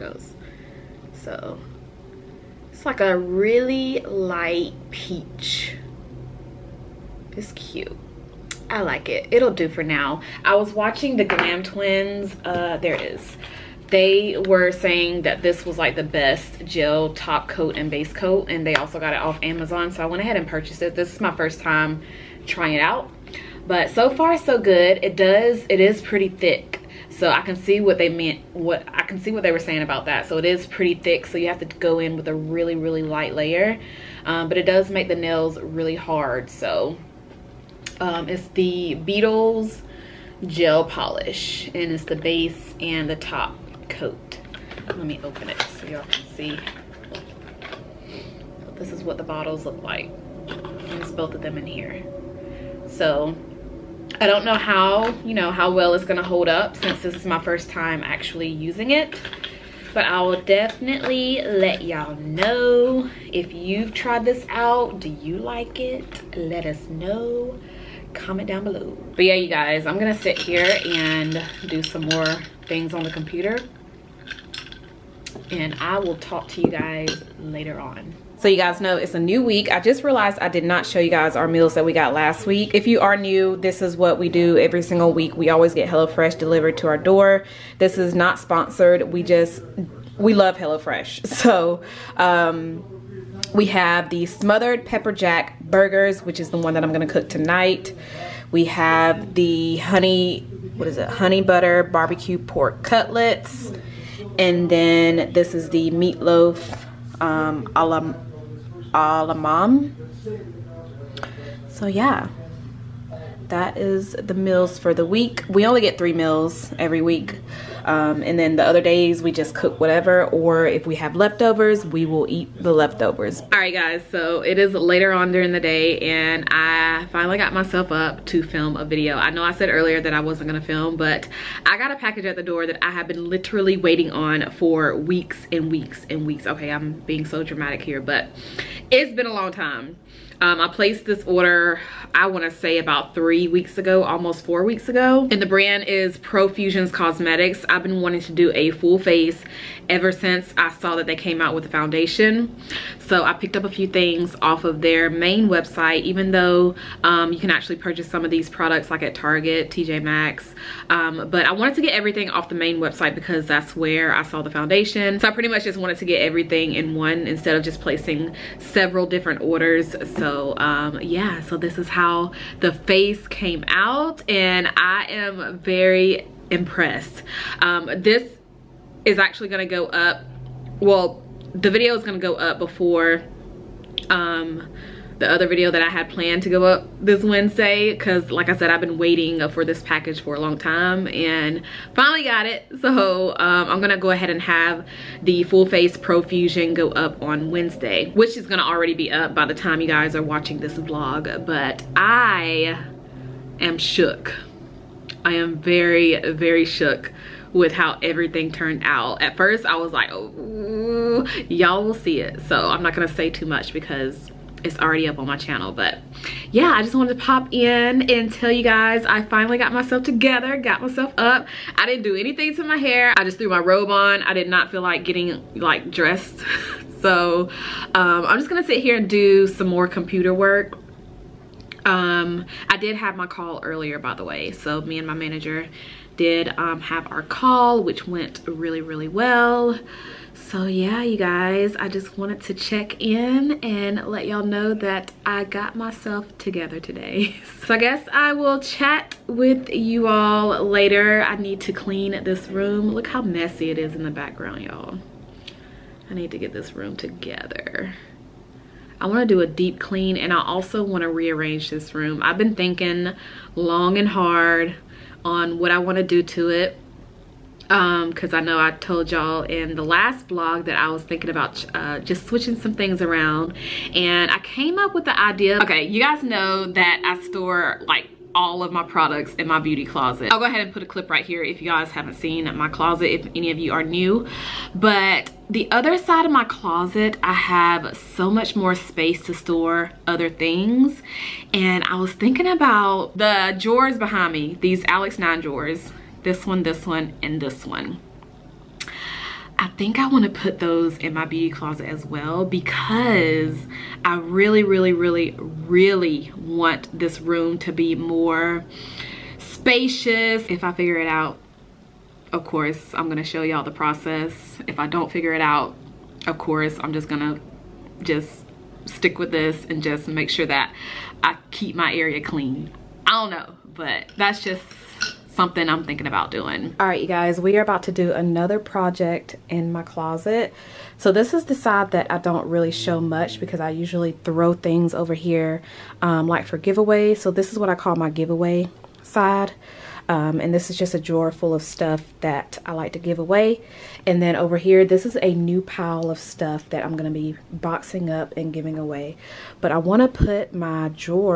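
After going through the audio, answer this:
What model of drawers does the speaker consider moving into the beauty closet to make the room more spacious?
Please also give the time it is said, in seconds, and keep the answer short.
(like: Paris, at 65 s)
Alex 9, at 294 s.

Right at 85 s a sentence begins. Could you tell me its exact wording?
We always get HelloFresh delivered to our door.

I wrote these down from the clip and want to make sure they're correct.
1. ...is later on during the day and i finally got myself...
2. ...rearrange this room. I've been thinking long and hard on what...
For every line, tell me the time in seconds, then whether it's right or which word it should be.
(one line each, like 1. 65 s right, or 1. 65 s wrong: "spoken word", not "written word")
1. 124 s right
2. 261 s right.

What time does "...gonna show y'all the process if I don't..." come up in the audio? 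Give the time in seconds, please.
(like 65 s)
313 s.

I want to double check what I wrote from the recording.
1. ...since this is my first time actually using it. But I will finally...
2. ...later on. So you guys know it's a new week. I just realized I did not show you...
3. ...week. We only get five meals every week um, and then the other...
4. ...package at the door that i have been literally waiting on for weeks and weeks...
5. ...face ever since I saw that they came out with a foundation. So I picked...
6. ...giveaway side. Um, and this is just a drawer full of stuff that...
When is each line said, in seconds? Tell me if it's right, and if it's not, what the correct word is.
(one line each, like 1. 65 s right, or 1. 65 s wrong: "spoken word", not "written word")
1. 56 s wrong: "definitely", not "finally"
2. 77 s right
3. 115 s wrong: "three", not "five"
4. 131 s right
5. 148 s right
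6. 338 s right.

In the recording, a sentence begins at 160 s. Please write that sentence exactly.
Um, but I wanted to get everything off the main website because that's where I saw the foundation.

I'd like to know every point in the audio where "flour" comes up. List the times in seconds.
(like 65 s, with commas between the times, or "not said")
not said.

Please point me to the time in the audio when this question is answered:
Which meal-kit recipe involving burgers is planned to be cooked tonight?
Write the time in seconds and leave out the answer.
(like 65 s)
94 s.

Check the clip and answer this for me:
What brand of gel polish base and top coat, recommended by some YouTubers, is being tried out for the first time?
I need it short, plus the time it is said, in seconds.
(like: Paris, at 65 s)
Beetles, at 38 s.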